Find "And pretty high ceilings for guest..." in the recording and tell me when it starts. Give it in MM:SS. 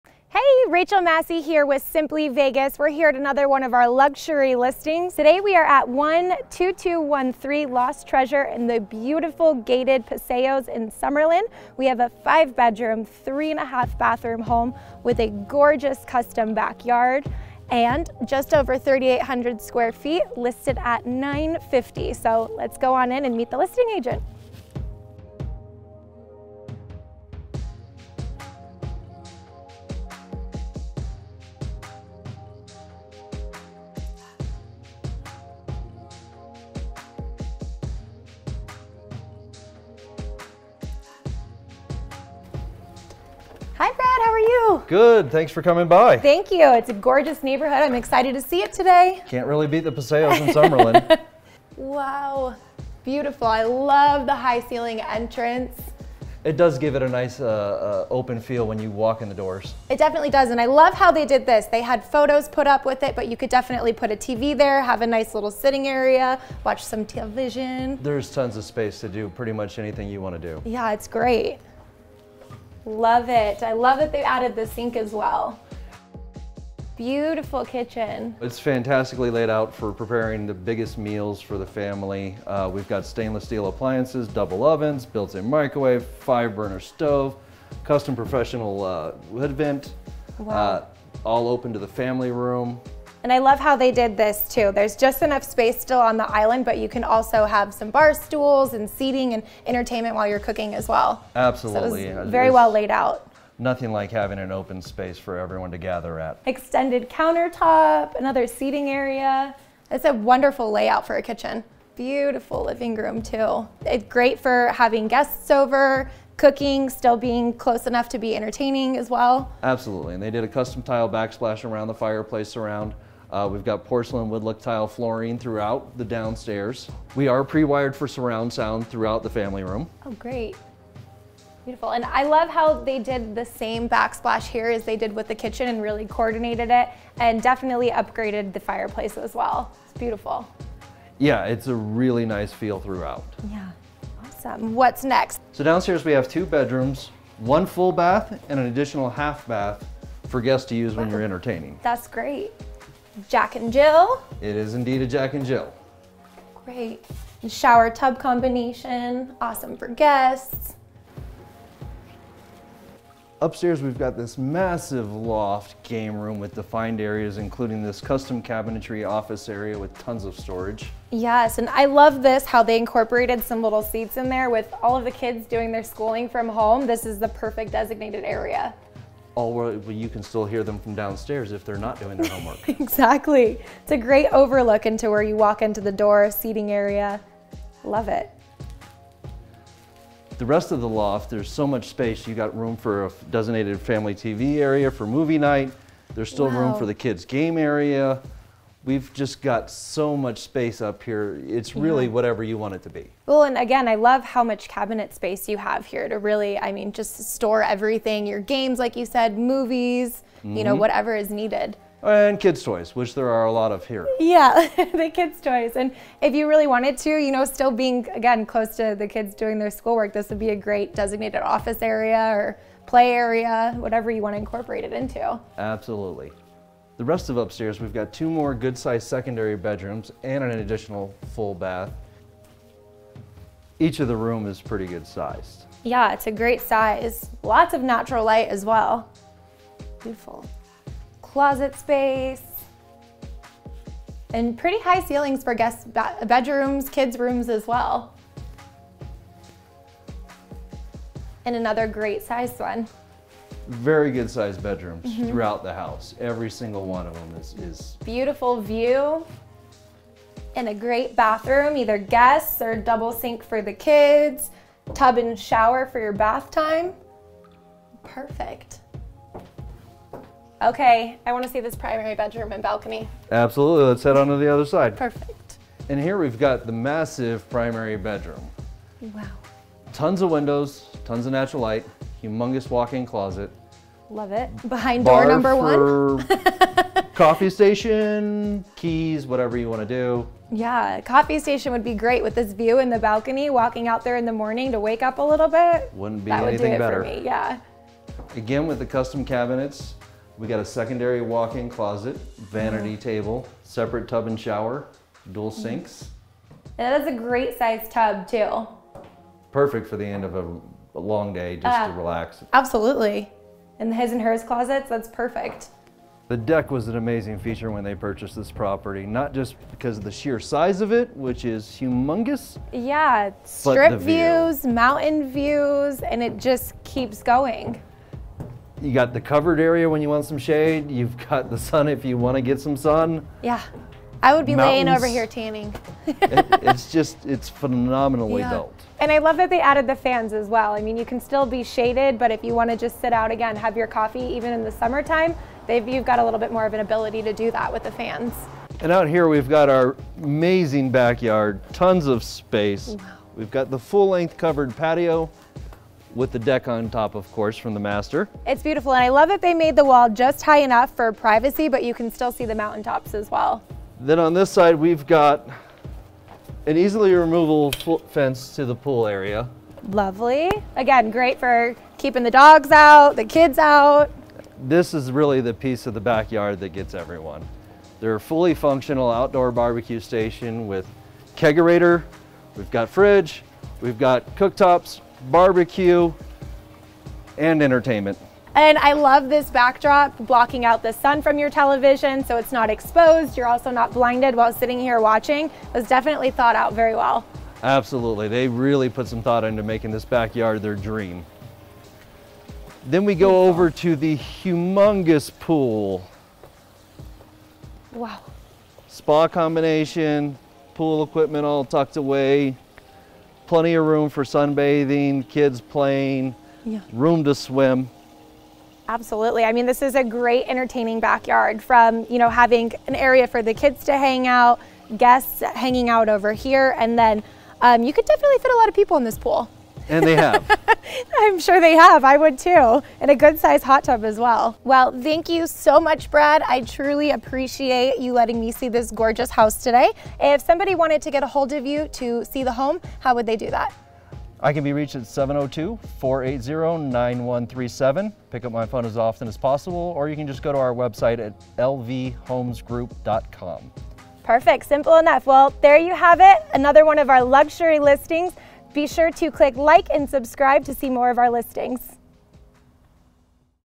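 04:04.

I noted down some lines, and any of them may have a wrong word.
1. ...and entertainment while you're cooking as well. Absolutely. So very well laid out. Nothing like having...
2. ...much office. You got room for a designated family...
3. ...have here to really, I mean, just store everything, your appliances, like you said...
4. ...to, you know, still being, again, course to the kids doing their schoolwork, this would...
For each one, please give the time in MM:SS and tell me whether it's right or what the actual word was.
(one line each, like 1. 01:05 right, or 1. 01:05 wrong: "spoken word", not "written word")
1. 01:39 right
2. 03:11 wrong: "space", not "office"
3. 03:25 wrong: "games", not "appliances"
4. 03:37 wrong: "close", not "course".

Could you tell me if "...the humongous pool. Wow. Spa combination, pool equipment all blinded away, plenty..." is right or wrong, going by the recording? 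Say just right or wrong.
wrong.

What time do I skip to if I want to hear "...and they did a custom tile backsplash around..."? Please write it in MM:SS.
02:00.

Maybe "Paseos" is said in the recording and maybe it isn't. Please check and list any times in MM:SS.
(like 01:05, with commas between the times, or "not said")
00:10, 00:49.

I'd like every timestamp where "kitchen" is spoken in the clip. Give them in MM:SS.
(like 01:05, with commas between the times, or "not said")
01:17, 01:51, 02:15.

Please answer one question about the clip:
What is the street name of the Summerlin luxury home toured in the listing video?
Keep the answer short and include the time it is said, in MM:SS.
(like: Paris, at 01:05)
Lost Treasure, at 00:07.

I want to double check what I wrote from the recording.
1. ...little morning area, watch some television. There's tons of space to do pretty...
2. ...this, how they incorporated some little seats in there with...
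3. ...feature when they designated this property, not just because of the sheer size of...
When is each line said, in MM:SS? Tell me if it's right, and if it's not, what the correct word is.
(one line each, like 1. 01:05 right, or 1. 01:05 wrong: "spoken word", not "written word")
1. 01:05 wrong: "sitting", not "morning"
2. 02:52 right
3. 05:17 wrong: "purchased", not "designated".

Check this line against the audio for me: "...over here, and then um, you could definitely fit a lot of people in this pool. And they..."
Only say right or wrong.
right.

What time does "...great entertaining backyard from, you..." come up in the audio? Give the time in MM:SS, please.
07:00.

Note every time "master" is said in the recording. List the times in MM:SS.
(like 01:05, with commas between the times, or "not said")
05:57.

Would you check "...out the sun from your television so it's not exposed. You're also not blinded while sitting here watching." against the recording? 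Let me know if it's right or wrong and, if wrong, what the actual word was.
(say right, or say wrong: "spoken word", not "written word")
right.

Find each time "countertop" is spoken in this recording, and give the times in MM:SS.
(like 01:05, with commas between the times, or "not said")
01:47.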